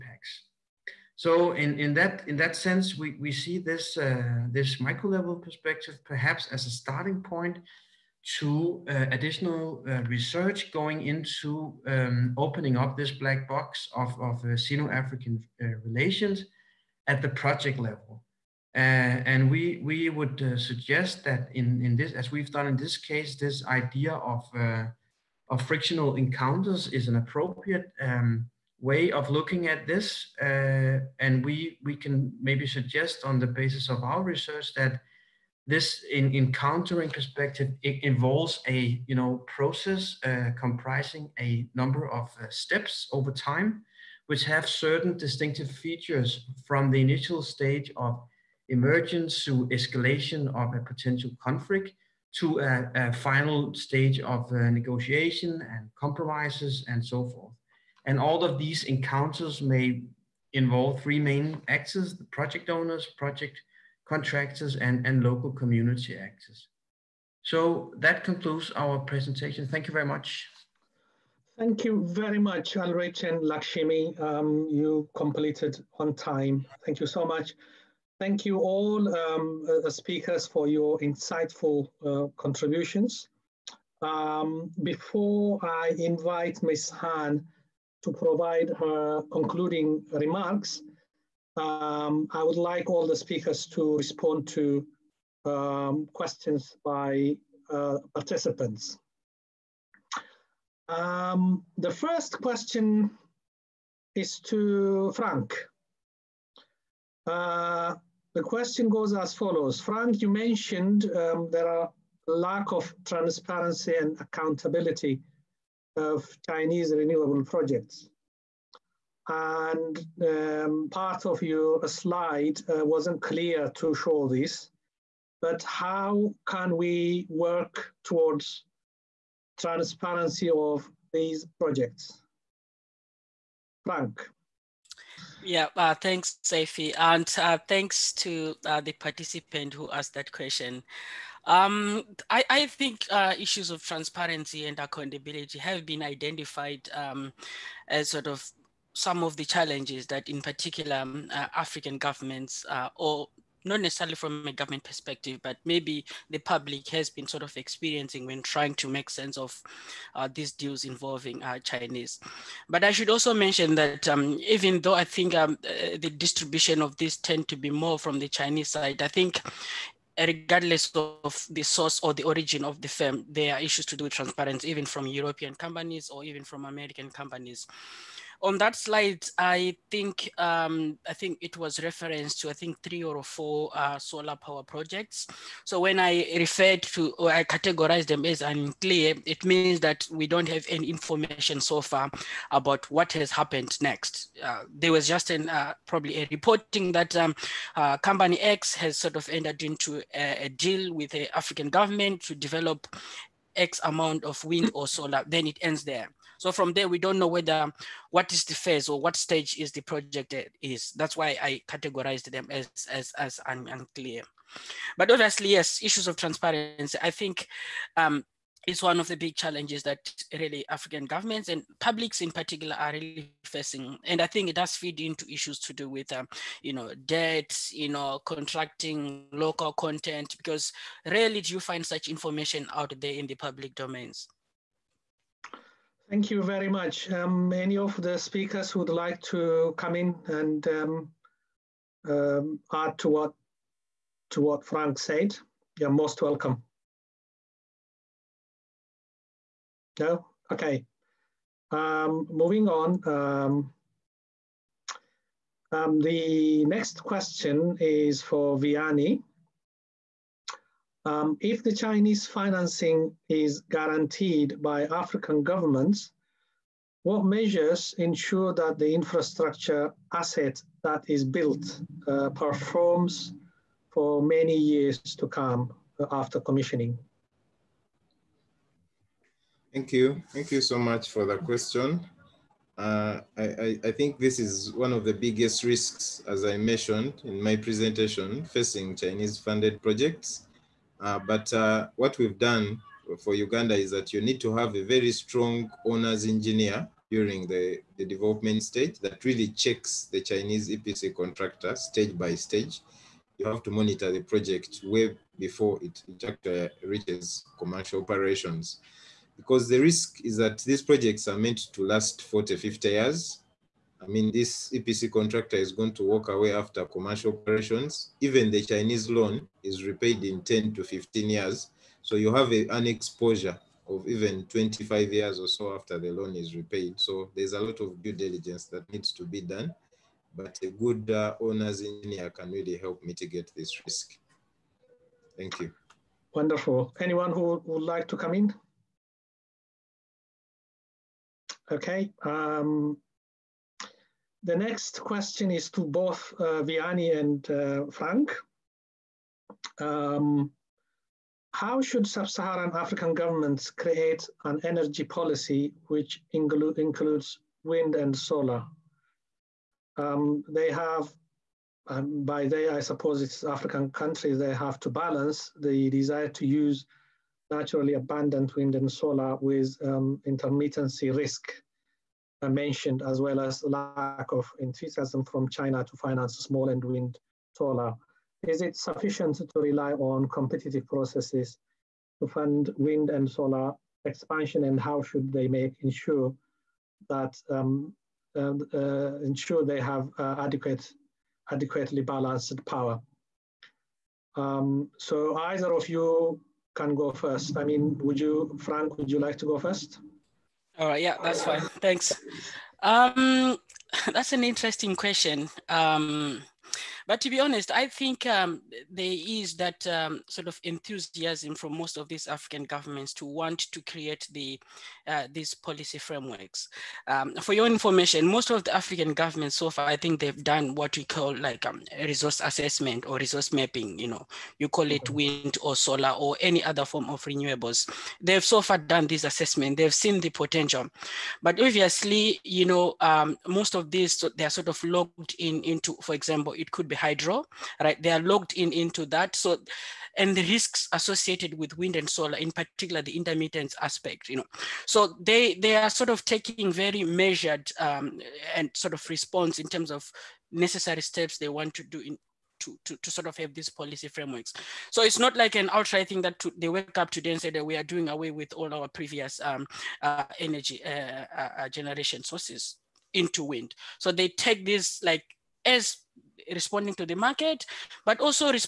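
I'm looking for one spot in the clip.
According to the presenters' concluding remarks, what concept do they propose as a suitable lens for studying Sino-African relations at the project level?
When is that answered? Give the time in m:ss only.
0:25.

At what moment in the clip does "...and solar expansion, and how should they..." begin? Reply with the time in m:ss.
6:23.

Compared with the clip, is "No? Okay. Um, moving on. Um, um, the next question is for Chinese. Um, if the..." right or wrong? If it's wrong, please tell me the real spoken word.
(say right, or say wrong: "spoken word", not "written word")
wrong: "Vianney", not "Chinese".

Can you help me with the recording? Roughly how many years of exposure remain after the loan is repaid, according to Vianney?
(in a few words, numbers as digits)
25 years.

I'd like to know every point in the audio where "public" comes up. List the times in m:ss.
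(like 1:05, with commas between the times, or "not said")
2:36, 3:41, 3:53.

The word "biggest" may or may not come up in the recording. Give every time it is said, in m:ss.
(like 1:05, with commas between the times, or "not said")
4:45.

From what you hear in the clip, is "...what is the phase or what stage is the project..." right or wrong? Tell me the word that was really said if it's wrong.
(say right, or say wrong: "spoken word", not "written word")
right.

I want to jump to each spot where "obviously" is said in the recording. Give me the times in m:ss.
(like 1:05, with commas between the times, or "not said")
3:35, 7:11.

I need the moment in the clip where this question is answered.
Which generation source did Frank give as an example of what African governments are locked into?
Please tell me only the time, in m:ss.
7:16.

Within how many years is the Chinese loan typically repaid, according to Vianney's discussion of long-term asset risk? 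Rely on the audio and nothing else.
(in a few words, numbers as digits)
10 to 15 years.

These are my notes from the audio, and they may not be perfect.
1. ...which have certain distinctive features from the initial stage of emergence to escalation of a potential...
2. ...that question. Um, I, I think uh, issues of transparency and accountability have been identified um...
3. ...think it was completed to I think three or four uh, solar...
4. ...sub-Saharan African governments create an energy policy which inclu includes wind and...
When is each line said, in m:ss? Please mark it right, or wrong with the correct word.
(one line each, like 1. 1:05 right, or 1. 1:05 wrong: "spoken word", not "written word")
1. 0:44 right
2. 2:20 right
3. 3:01 wrong: "referenced", not "completed"
4. 5:52 right.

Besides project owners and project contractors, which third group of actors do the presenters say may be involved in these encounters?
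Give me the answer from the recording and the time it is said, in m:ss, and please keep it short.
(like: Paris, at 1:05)
local community actors, at 1:05.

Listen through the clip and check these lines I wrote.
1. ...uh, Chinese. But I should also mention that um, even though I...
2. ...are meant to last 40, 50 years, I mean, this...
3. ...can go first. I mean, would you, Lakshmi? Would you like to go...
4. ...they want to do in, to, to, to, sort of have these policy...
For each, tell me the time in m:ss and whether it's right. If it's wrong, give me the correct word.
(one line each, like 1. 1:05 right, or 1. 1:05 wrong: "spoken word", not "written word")
1. 2:41 right
2. 5:11 right
3. 6:36 wrong: "Frank", not "Lakshmi"
4. 7:31 right.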